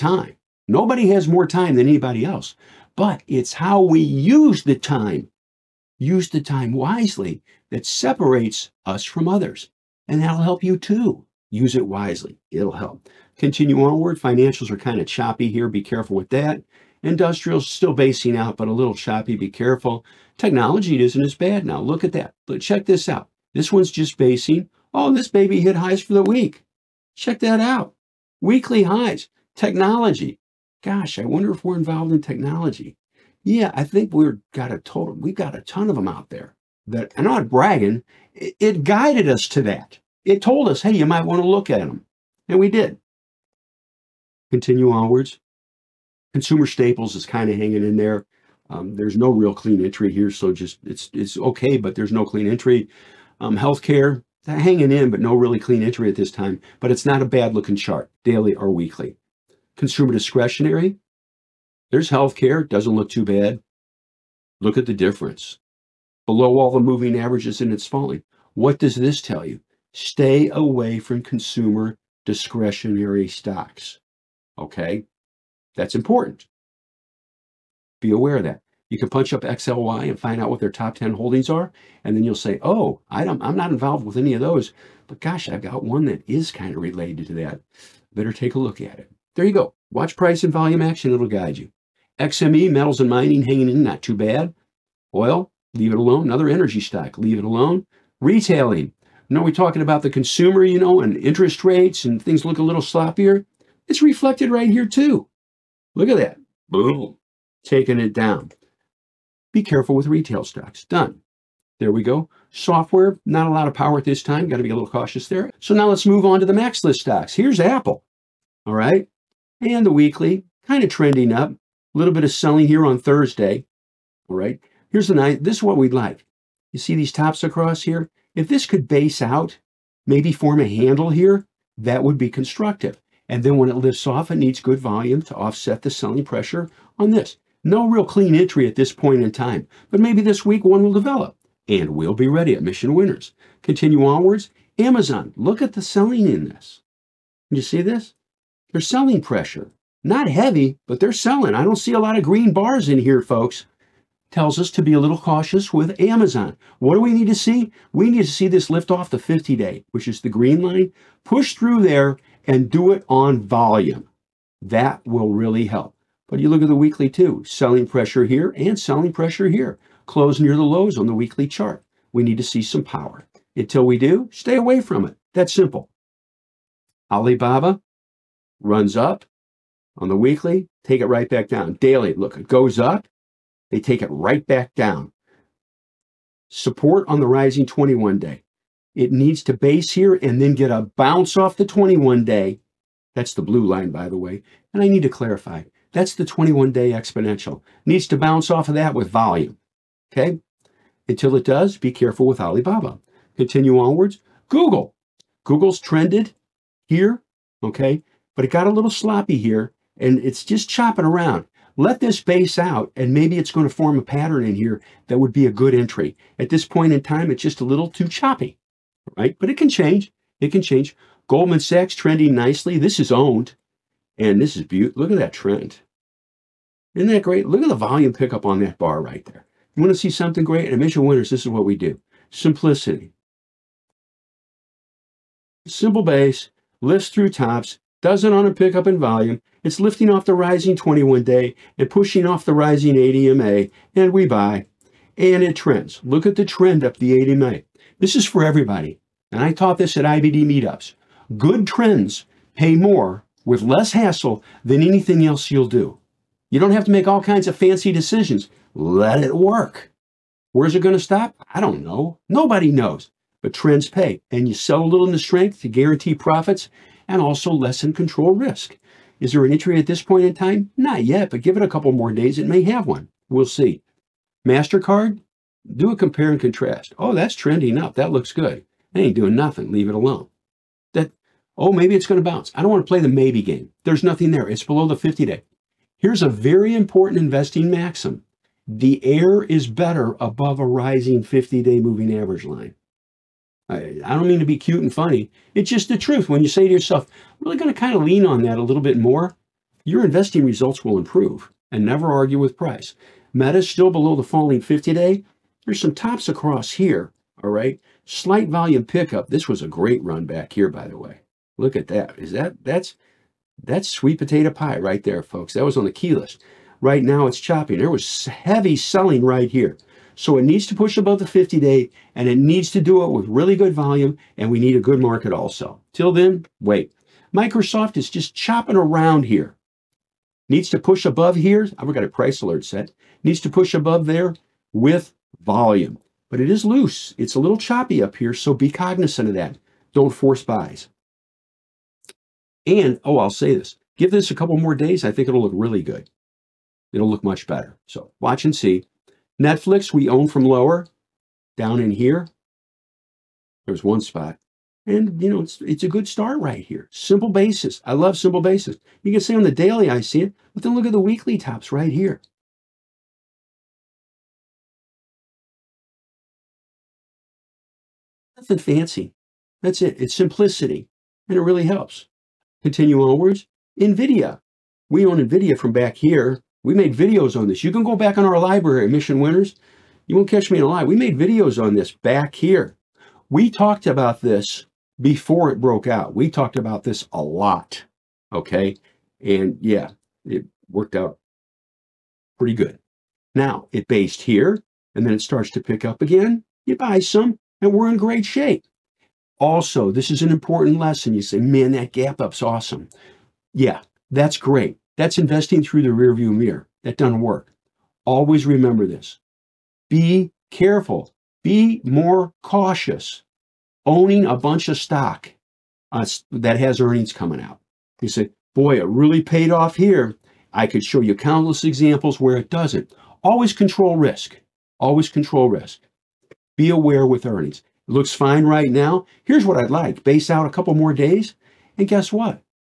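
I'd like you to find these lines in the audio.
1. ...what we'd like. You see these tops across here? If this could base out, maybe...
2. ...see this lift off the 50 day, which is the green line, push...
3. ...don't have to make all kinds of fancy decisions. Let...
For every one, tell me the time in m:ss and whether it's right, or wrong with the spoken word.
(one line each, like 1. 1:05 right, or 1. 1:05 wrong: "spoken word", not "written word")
1. 2:05 right
2. 2:38 right
3. 4:16 right.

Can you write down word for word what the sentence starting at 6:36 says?
You buy some, and we're in great shape.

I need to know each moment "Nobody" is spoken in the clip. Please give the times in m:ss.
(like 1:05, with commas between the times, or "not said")
0:00, 4:22.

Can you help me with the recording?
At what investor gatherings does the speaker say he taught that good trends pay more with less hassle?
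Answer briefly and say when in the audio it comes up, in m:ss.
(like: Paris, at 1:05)
IBD meetups, at 4:10.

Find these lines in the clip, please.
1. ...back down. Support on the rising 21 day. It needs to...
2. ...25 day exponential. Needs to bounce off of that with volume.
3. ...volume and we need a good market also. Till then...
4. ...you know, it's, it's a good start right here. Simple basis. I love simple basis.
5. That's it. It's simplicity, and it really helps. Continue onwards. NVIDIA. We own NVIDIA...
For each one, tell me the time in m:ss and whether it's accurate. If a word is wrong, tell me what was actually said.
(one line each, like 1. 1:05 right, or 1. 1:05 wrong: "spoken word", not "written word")
1. 3:04 right
2. 3:16 wrong: "21", not "25"
3. 5:23 right
4. 5:55 right
5. 6:09 right.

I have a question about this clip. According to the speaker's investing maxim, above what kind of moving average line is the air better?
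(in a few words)
rising 50 day.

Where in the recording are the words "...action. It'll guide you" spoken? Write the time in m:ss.
1:30.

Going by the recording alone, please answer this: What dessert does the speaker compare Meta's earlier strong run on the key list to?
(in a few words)
sweet potato pie.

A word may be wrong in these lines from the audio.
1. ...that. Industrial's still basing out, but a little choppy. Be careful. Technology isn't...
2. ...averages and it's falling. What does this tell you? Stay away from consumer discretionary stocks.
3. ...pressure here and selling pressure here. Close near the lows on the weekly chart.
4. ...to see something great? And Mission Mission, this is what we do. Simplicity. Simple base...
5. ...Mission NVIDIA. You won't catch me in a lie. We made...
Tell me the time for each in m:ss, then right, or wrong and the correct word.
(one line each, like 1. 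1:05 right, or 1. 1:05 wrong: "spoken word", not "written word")
1. 0:16 right
2. 1:07 right
3. 2:47 right
4. 3:49 wrong: "Winners", not "Mission"
5. 6:18 wrong: "Winners", not "NVIDIA".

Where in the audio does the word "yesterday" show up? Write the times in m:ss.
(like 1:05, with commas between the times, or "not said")
not said.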